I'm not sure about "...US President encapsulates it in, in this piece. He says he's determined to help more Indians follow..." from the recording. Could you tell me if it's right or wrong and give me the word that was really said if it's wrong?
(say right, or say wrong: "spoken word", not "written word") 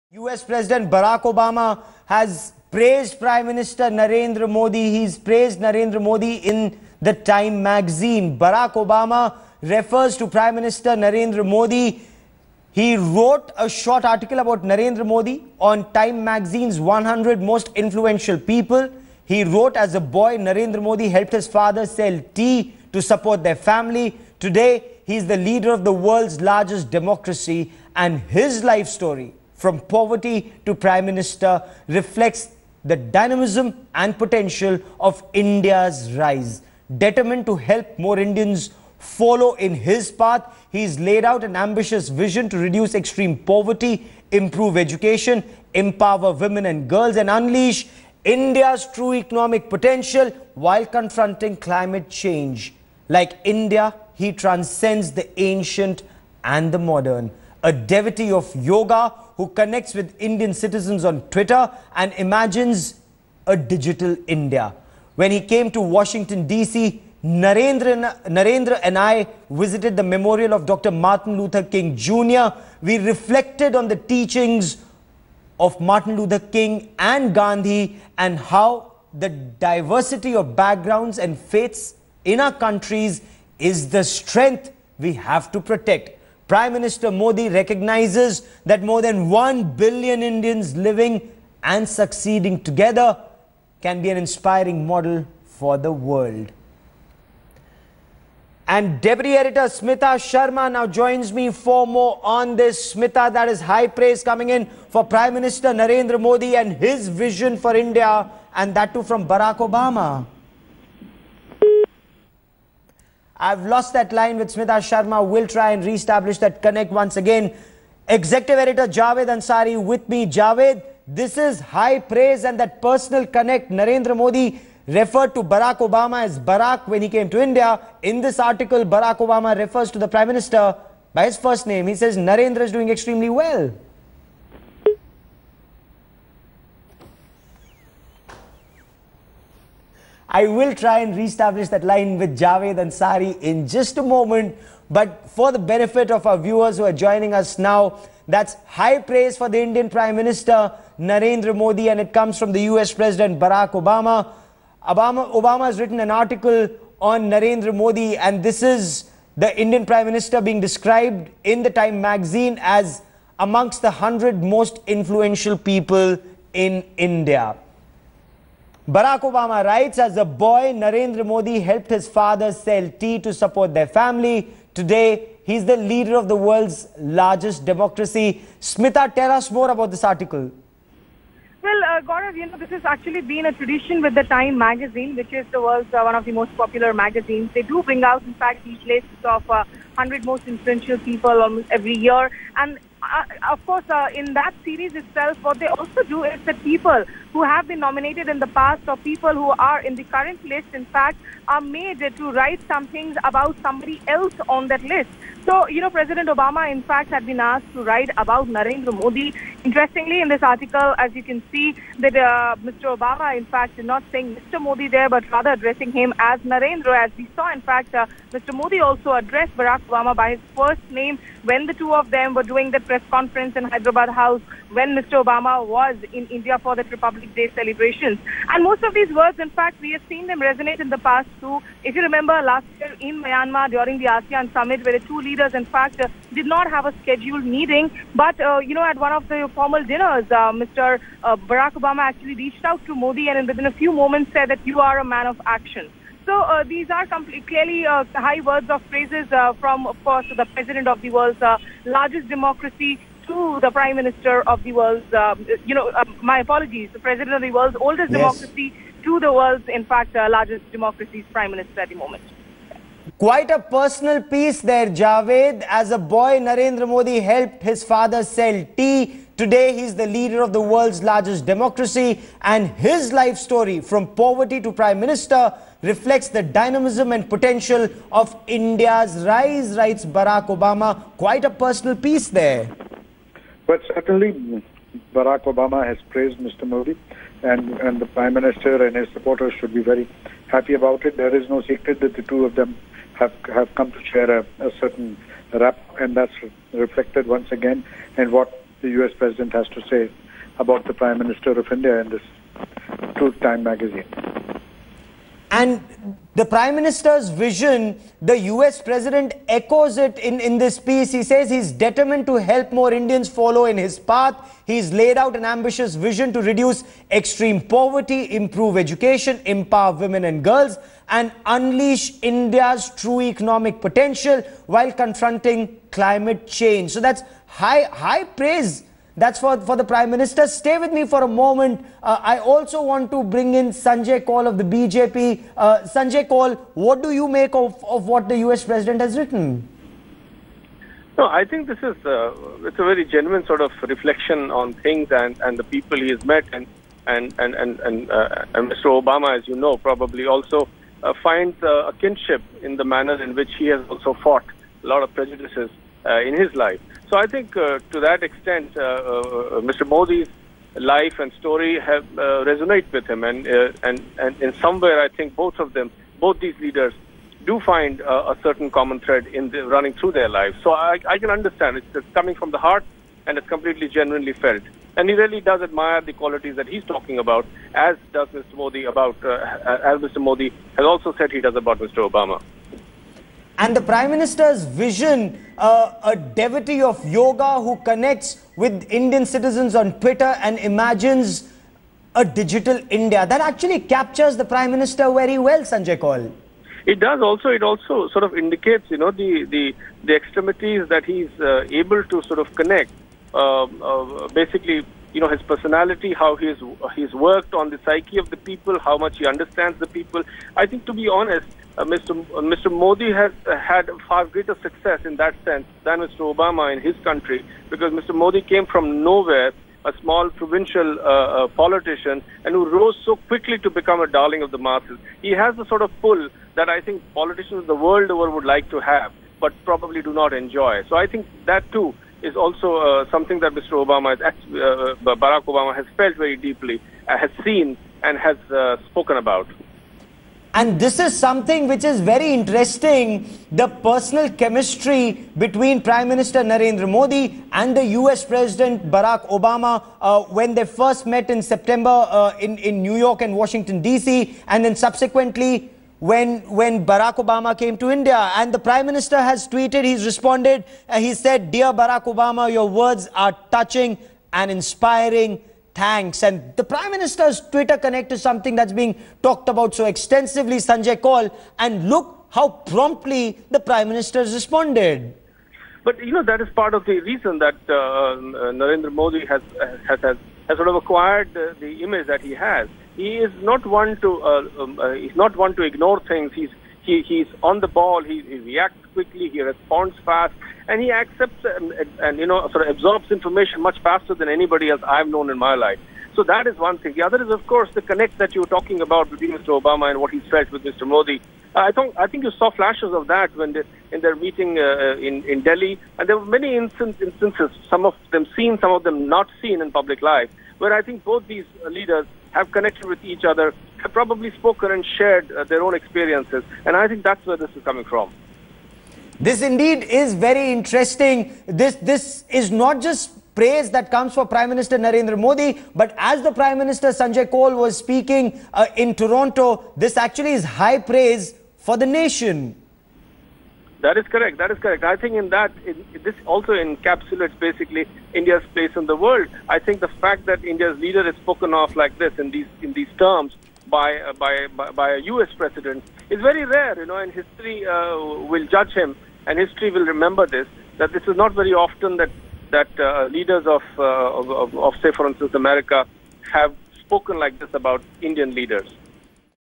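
wrong: "echoes", not "encapsulates".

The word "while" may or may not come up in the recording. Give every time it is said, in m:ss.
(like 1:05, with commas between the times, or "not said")
0:50, 5:24.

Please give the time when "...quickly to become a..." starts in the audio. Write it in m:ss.
7:03.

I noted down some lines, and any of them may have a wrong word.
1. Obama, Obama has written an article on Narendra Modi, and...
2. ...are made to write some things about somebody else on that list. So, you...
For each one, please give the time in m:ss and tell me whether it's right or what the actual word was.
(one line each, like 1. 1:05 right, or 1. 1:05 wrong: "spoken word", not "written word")
1. 2:34 right
2. 3:21 right.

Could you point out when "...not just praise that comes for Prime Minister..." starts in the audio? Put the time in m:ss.
8:42.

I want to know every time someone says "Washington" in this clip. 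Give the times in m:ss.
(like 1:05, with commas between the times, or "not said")
1:05, 7:33.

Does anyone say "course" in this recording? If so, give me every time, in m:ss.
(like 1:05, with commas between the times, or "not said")
3:13, 4:10, 8:17.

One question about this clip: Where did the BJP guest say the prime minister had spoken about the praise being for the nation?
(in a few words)
Toronto.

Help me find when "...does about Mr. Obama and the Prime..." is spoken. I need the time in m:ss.
6:21.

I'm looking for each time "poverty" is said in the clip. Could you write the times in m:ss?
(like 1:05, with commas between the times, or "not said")
0:29, 0:43, 4:34, 5:17.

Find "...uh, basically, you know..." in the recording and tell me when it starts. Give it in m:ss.
6:43.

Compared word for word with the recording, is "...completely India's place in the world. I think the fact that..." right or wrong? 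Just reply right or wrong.
wrong.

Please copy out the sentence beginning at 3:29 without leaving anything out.
Interestingly, in this article, as you can see, that uh, Mr.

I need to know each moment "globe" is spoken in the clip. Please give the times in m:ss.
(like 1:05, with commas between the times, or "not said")
not said.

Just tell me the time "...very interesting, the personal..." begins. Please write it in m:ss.
7:22.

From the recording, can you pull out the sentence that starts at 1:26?
Prime Minister Modi recognizes that more than 1 billion Indians living and succeeding together can be an inspiring model for the world.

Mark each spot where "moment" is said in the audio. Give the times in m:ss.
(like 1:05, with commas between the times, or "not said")
2:24, 4:04, 4:22, 5:31.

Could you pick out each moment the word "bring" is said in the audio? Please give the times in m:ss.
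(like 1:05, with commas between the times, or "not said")
3:07, 5:33.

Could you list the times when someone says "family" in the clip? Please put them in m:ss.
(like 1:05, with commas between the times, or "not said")
0:23, 2:53.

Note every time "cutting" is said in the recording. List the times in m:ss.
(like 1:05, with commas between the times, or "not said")
not said.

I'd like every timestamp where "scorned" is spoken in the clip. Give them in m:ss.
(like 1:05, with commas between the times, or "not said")
not said.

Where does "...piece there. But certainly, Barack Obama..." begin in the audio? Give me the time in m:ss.
4:41.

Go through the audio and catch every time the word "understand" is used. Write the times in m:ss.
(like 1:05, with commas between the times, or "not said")
6:11, 6:49.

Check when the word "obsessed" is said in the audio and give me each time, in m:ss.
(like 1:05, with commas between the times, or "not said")
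not said.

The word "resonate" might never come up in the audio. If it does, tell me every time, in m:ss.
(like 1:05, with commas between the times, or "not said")
3:50, 6:02.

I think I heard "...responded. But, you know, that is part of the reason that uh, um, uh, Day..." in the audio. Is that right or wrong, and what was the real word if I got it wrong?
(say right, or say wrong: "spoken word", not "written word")
wrong: "Narendra", not "Day".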